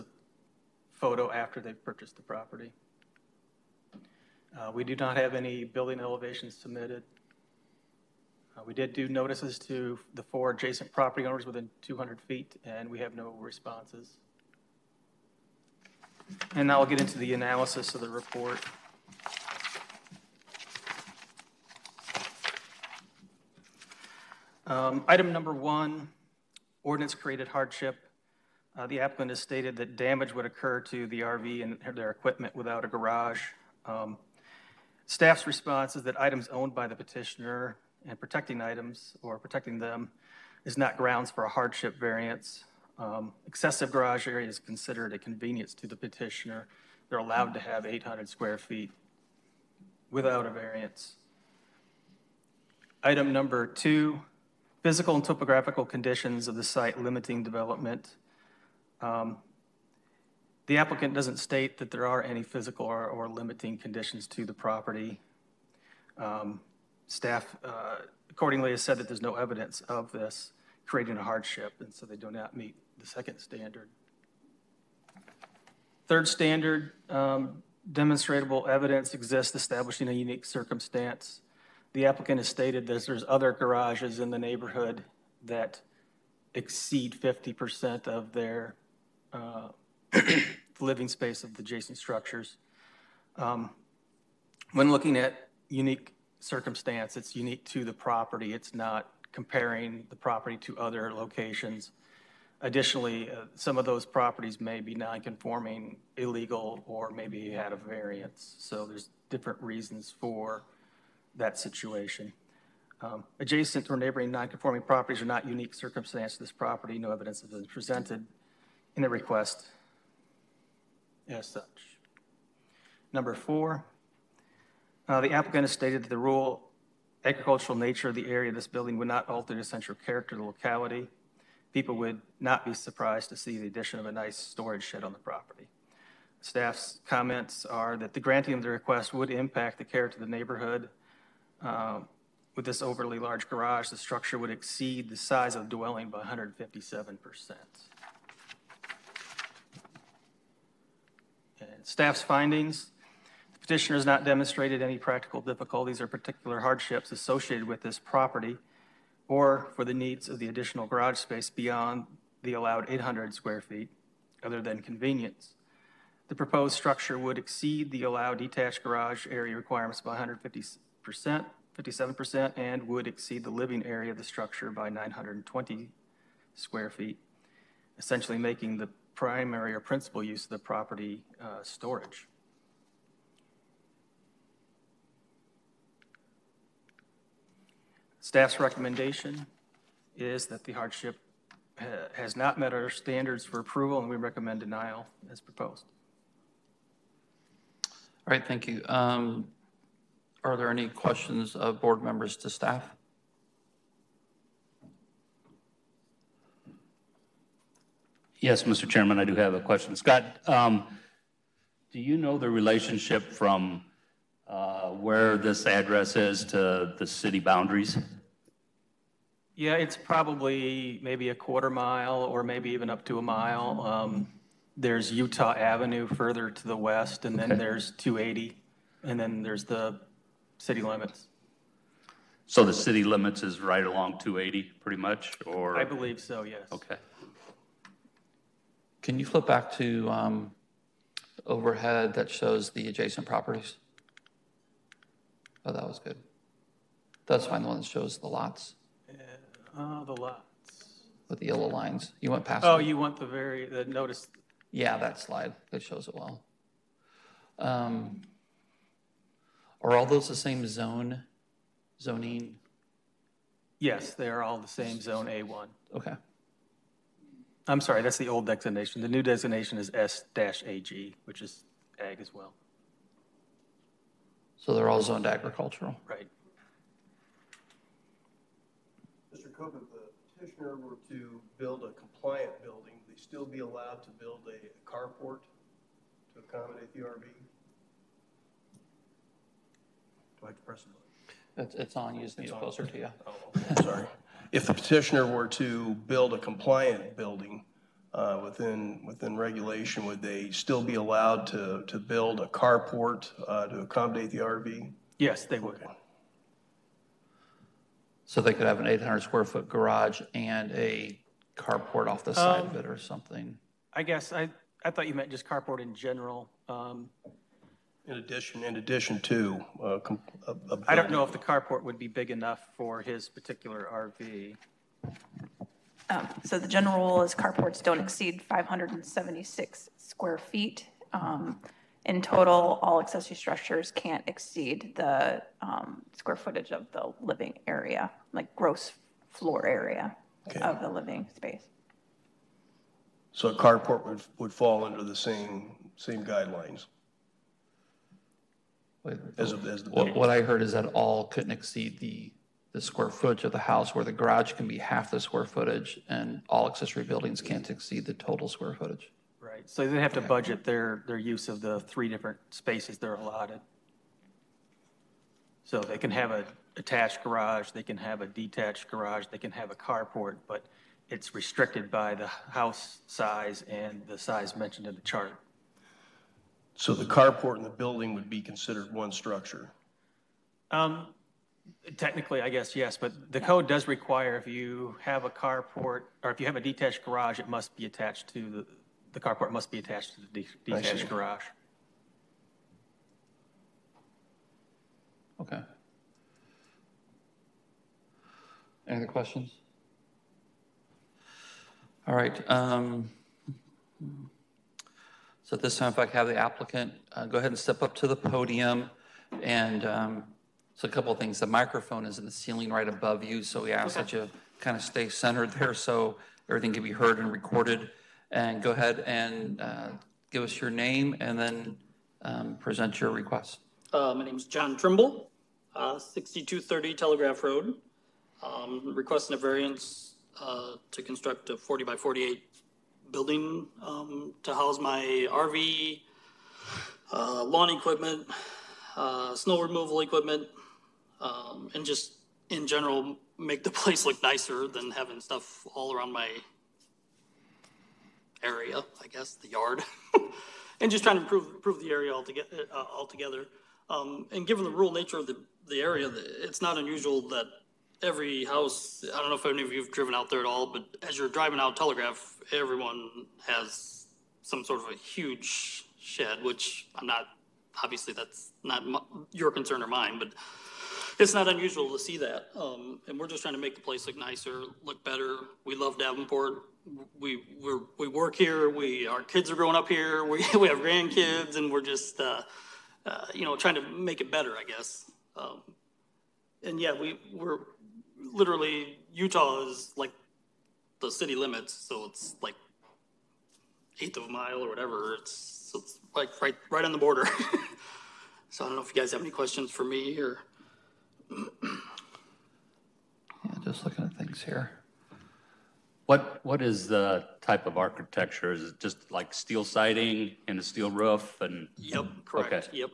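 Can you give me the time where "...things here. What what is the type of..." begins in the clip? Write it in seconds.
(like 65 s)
504 s.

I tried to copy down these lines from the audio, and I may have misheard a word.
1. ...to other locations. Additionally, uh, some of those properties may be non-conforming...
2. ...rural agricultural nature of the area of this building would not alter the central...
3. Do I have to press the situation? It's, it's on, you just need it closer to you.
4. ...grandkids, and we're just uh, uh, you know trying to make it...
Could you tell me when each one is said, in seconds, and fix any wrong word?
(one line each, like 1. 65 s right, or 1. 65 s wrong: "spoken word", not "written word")
1. 100 s right
2. 126 s right
3. 290 s wrong: "button", not "situation"
4. 480 s right.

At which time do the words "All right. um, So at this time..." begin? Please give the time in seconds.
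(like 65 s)
402 s.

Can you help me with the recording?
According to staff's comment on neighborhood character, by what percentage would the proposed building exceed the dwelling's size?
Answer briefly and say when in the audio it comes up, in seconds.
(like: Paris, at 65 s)
157%, at 146 s.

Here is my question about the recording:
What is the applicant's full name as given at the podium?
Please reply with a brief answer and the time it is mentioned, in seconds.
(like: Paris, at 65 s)
John Trimble, at 424 s.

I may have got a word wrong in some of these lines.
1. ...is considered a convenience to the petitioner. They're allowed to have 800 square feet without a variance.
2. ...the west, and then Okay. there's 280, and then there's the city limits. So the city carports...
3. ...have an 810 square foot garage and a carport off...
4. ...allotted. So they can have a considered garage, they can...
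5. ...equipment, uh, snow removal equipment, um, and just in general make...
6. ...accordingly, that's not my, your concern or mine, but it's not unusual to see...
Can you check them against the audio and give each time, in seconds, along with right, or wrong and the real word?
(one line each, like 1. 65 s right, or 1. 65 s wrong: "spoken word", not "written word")
1. 44 s right
2. 226 s wrong: "limits", not "carports"
3. 308 s wrong: "800", not "810"
4. 363 s wrong: "attached", not "considered"
5. 437 s right
6. 467 s wrong: "obviously", not "accordingly".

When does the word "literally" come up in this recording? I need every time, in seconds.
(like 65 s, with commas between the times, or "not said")
488 s.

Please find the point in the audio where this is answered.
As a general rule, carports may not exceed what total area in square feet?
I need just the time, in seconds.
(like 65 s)
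328 s.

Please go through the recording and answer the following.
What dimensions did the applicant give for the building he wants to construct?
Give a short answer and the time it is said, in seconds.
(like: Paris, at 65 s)
40 by 48, at 431 s.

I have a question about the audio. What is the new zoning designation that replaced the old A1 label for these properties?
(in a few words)
S-AG.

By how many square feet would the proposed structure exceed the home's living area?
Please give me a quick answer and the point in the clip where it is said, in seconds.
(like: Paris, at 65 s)
920, at 174 s.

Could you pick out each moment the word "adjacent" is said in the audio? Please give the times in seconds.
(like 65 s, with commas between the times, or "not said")
10 s, 91 s, 113 s, 242 s.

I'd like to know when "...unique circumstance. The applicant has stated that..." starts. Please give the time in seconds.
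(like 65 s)
80 s.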